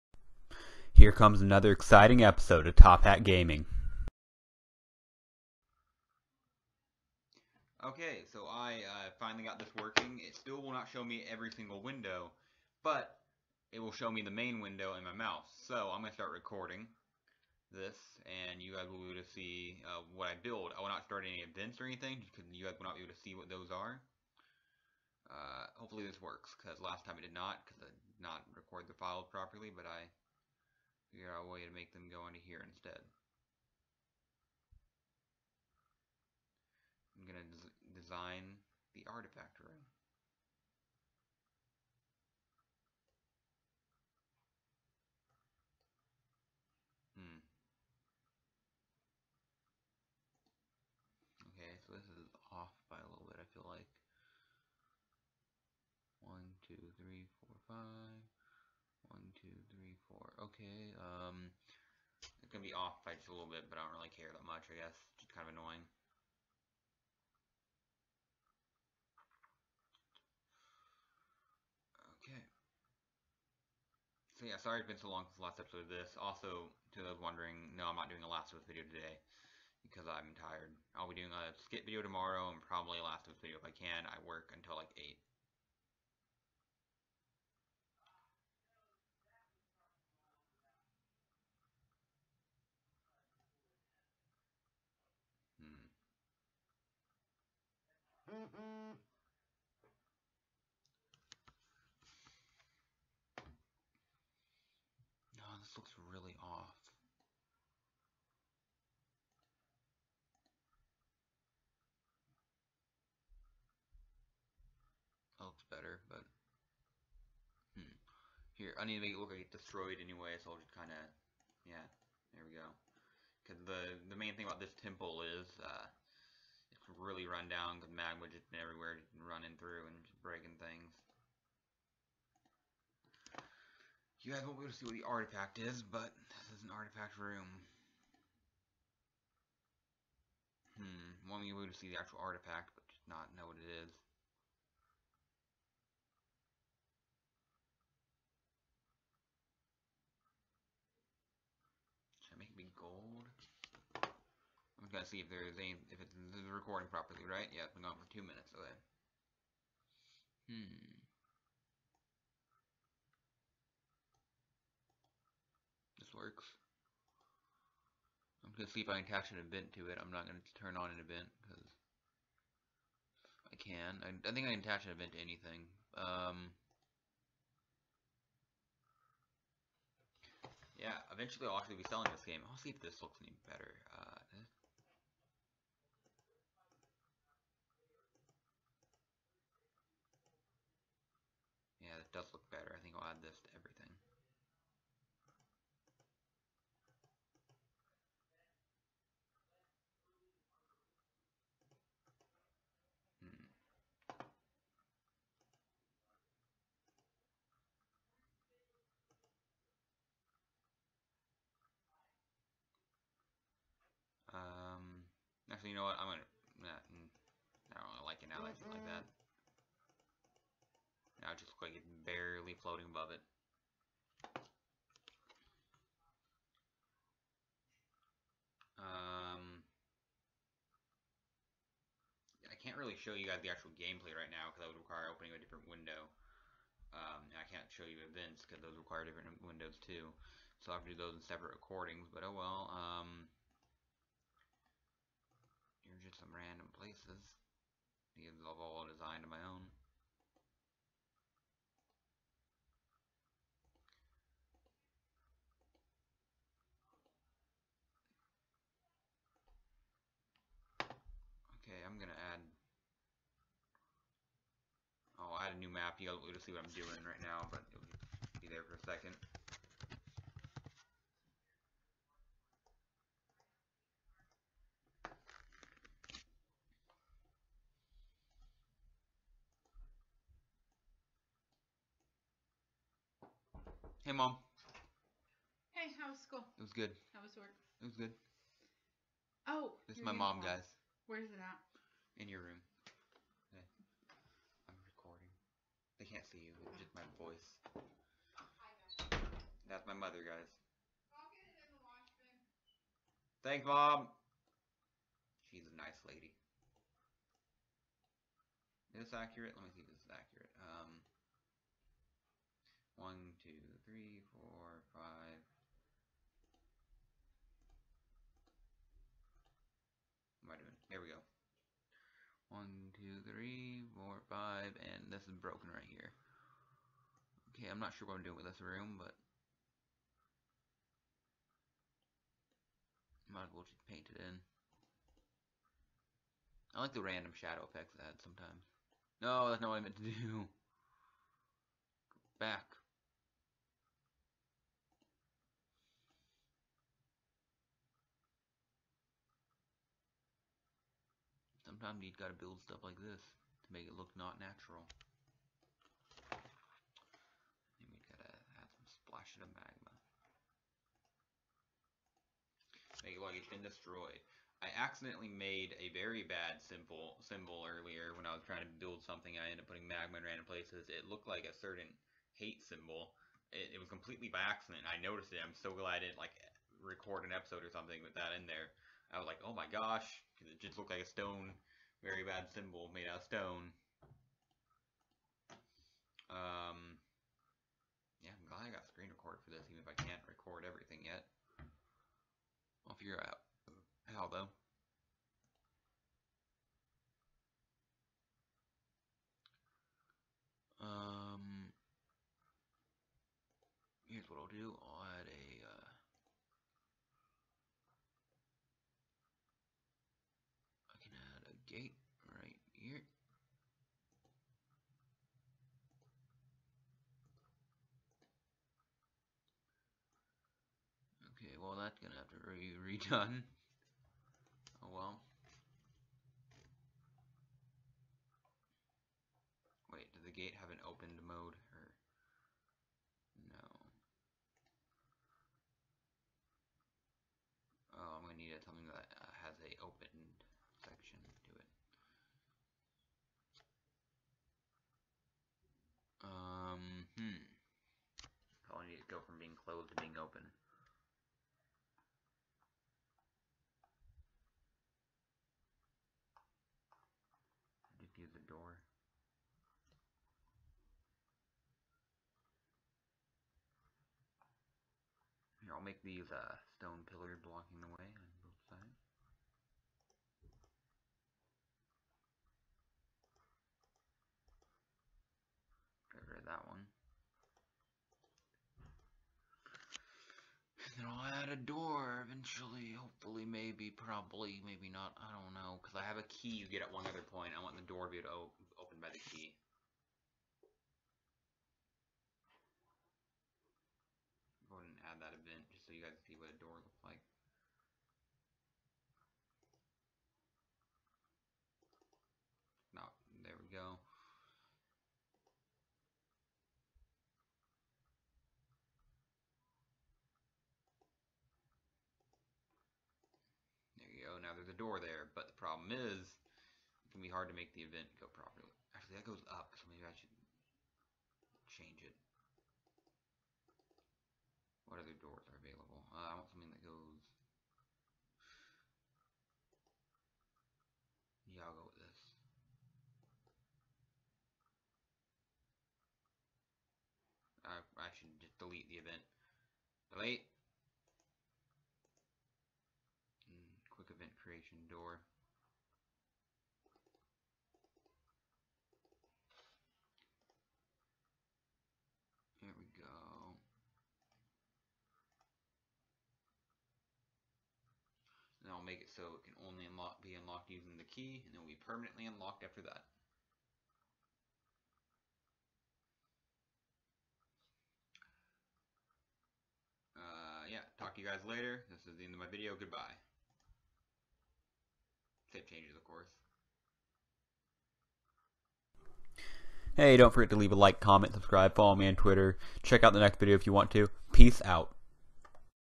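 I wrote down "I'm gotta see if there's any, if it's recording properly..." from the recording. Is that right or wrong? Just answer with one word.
right.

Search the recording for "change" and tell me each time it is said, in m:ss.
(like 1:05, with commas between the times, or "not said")
8:41, 9:35.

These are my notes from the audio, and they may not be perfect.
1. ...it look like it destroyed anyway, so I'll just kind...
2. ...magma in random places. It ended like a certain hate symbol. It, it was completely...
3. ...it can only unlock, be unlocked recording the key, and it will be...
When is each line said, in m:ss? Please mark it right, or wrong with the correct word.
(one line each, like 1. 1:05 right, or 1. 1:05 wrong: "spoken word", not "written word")
1. 1:59 right
2. 6:09 wrong: "looked", not "ended"
3. 9:19 wrong: "using", not "recording".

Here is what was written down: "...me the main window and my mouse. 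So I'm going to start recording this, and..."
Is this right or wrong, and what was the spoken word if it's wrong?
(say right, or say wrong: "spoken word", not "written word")
right.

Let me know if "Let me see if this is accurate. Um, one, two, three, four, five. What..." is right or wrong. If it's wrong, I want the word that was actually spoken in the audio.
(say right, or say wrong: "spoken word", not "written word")
right.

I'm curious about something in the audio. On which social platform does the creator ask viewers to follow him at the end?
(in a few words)
Twitter.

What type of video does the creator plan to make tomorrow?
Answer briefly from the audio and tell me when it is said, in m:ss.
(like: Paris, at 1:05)
Skit video, at 1:21.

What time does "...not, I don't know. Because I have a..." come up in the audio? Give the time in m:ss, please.
8:04.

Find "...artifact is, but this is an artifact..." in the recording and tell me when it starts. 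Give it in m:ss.
2:15.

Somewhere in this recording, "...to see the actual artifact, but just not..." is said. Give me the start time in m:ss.
2:21.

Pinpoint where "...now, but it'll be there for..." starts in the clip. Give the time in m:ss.
4:27.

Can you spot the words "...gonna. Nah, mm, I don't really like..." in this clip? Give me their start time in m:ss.
3:36.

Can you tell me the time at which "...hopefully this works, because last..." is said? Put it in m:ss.
0:25.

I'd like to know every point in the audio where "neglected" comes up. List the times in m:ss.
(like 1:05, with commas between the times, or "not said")
not said.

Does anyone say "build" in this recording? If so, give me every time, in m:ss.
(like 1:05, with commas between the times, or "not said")
0:20, 5:52, 6:08.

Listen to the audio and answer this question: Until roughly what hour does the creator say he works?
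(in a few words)
8.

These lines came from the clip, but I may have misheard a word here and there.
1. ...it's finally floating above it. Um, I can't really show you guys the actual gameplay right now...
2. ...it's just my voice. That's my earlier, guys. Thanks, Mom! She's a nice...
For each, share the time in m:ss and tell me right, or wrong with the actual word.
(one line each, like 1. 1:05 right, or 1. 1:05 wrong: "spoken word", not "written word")
1. 3:41 wrong: "barely", not "finally"
2. 4:56 wrong: "mother", not "earlier".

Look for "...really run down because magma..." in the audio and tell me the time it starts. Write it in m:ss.
2:06.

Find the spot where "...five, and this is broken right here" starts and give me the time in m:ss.
5:24.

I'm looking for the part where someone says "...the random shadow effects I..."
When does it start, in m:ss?
5:36.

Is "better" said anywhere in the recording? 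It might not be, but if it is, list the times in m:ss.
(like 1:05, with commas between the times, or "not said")
1:55, 3:03.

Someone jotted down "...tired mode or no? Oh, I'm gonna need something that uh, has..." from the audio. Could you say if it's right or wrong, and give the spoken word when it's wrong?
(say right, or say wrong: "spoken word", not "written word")
wrong: "opened", not "tired".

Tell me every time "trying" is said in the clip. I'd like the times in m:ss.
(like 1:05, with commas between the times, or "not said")
6:08.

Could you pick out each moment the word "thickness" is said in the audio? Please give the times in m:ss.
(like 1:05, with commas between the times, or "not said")
not said.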